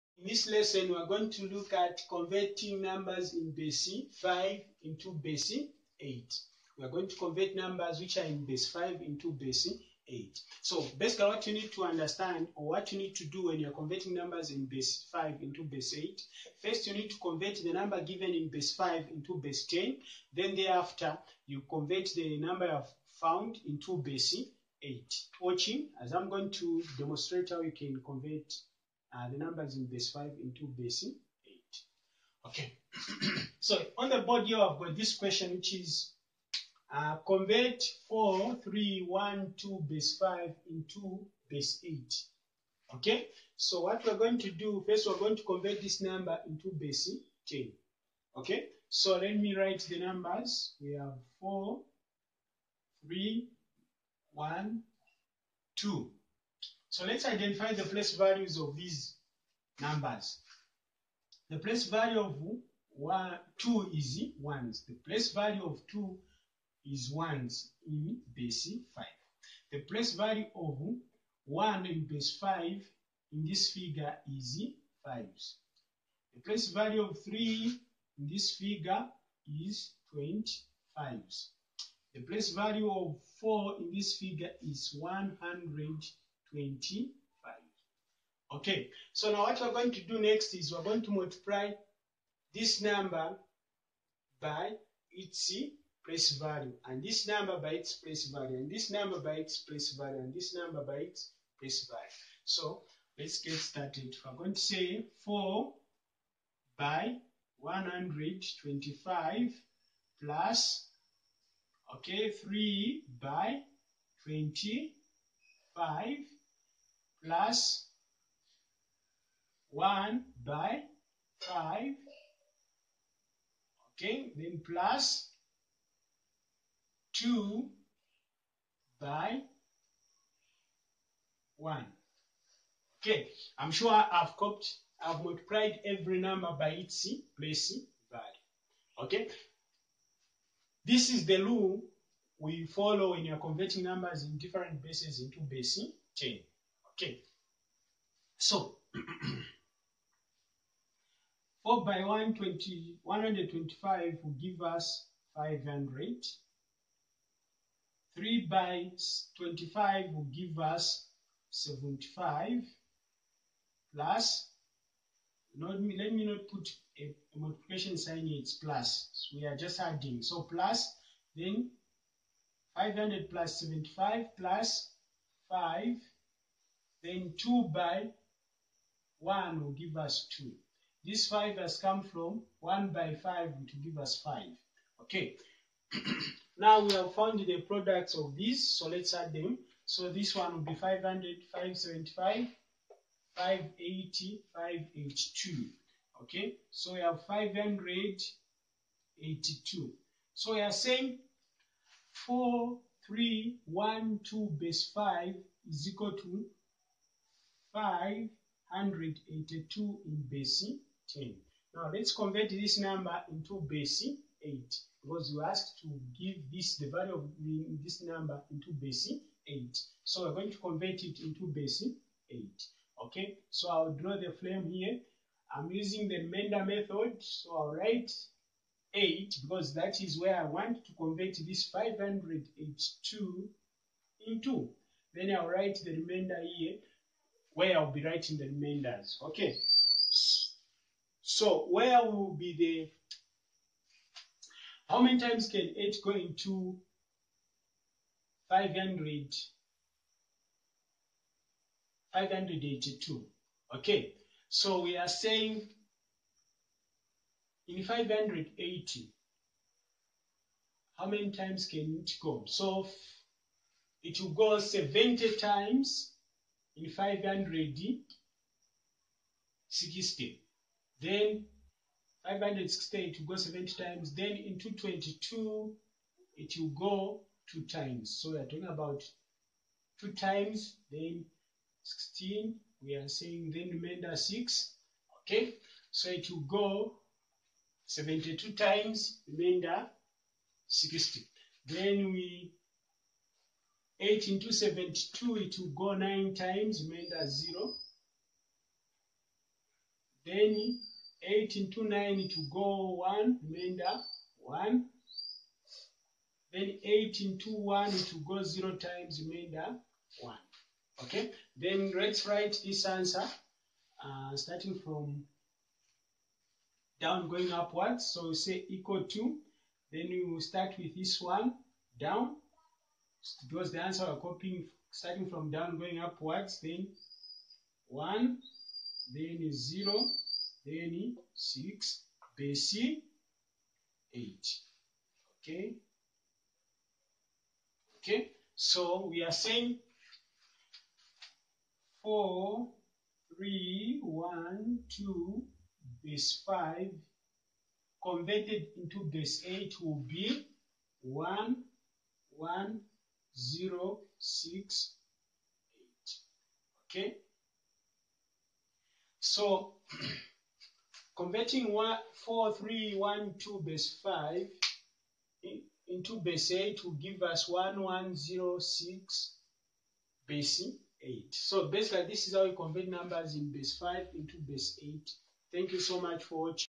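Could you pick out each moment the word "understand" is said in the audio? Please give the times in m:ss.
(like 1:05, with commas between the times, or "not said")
0:11.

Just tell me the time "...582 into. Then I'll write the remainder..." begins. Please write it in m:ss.
3:51.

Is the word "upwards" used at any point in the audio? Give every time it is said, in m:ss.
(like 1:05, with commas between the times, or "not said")
5:17, 5:25.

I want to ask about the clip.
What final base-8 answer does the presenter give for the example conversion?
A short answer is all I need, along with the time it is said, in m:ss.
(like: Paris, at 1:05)
1106, at 6:07.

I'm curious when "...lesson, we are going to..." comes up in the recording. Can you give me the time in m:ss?
0:00.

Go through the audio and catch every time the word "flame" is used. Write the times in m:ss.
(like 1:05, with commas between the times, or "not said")
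3:44.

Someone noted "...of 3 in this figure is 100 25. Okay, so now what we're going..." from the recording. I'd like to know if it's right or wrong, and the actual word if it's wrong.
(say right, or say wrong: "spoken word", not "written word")
wrong: "4", not "3".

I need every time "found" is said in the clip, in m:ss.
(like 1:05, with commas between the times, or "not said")
0:23, 3:07.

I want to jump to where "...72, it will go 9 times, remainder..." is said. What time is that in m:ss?
4:54.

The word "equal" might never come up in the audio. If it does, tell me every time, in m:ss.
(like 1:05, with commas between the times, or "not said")
3:25, 5:18.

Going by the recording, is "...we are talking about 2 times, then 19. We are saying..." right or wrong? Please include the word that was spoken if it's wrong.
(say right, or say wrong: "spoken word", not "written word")
wrong: "16", not "19".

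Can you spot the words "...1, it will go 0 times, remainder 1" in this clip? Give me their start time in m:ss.
5:07.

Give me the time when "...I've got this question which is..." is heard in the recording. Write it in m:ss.
0:34.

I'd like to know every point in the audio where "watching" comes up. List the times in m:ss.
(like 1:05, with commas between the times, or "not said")
0:25, 6:16.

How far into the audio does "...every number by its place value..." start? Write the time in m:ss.
2:15.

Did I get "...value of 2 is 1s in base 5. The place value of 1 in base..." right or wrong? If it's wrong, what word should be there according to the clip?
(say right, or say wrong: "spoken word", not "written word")
right.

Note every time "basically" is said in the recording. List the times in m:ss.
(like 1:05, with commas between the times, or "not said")
0:10, 6:11.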